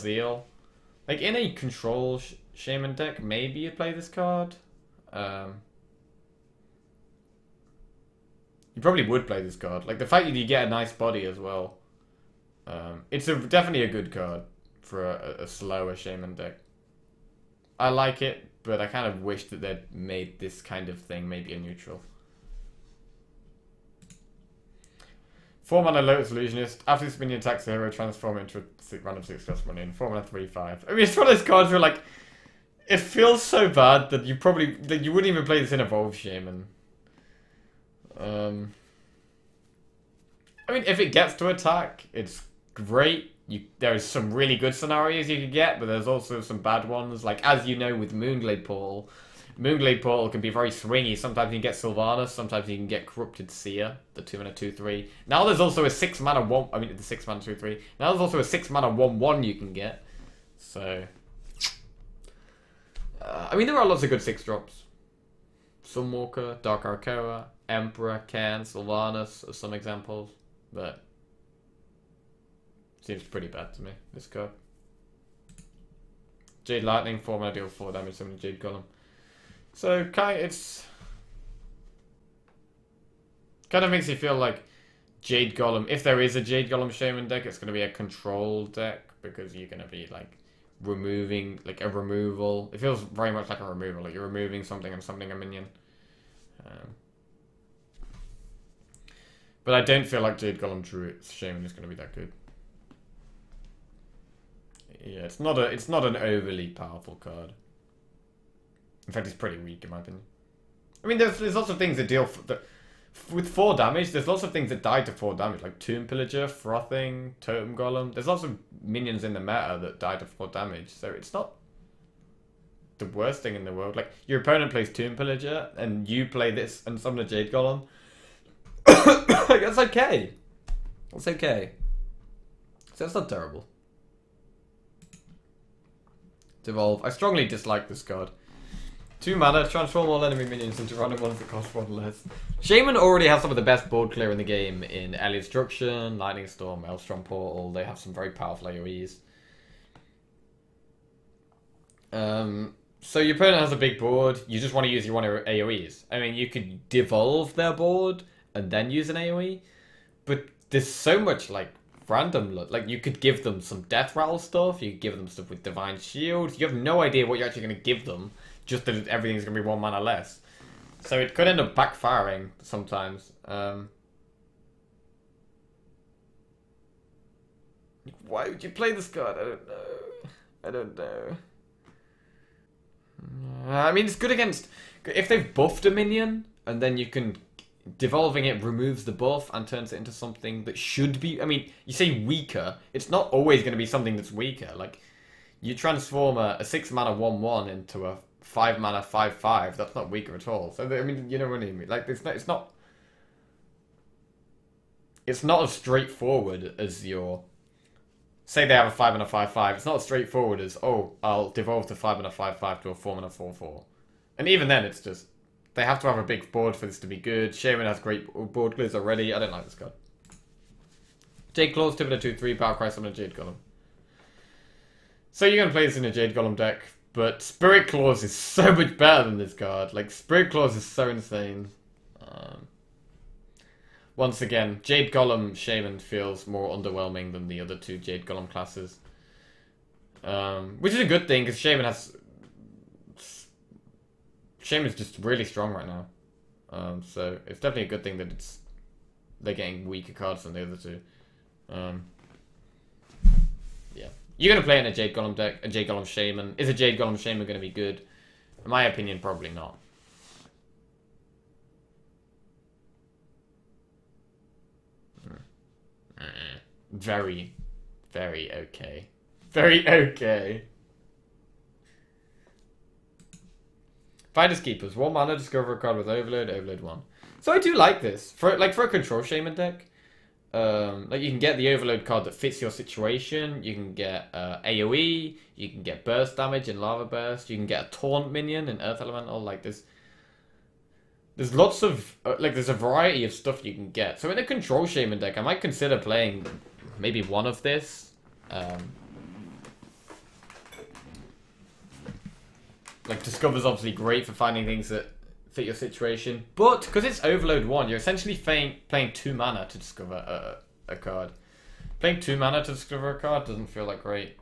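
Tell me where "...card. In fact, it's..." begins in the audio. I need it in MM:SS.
01:47.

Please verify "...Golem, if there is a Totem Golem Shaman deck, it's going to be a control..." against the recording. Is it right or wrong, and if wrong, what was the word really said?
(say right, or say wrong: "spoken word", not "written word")
wrong: "Jade", not "Totem".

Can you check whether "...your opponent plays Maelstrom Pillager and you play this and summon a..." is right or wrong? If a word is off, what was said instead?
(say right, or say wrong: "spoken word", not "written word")
wrong: "Tomb", not "Maelstrom".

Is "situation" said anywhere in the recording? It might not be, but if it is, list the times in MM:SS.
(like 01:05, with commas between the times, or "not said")
04:42, 05:05.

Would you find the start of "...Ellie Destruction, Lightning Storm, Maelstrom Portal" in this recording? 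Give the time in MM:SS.
02:25.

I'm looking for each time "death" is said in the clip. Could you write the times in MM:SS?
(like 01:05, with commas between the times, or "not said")
02:43.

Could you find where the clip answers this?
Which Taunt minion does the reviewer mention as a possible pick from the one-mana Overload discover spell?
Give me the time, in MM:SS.
04:48.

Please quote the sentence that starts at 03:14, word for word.
Like you transform a, a six mana one one into a five mana five five.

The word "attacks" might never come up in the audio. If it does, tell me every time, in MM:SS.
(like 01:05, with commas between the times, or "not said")
00:27, 00:41.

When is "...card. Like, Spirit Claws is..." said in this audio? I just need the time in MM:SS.
03:49.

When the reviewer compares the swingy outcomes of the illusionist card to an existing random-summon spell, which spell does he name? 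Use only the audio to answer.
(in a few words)
Moonglade Portal.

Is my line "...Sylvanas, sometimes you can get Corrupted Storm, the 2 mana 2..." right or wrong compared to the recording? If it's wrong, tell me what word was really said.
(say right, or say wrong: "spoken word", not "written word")
wrong: "Seer", not "Storm".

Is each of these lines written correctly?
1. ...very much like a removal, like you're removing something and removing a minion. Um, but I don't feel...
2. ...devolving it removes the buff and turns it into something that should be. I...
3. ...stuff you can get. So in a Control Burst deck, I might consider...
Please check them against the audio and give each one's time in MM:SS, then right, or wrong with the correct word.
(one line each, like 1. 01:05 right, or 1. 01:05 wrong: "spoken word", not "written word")
1. 01:33 wrong: "summoning", not "removing"
2. 03:07 right
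3. 04:53 wrong: "Shaman", not "Burst".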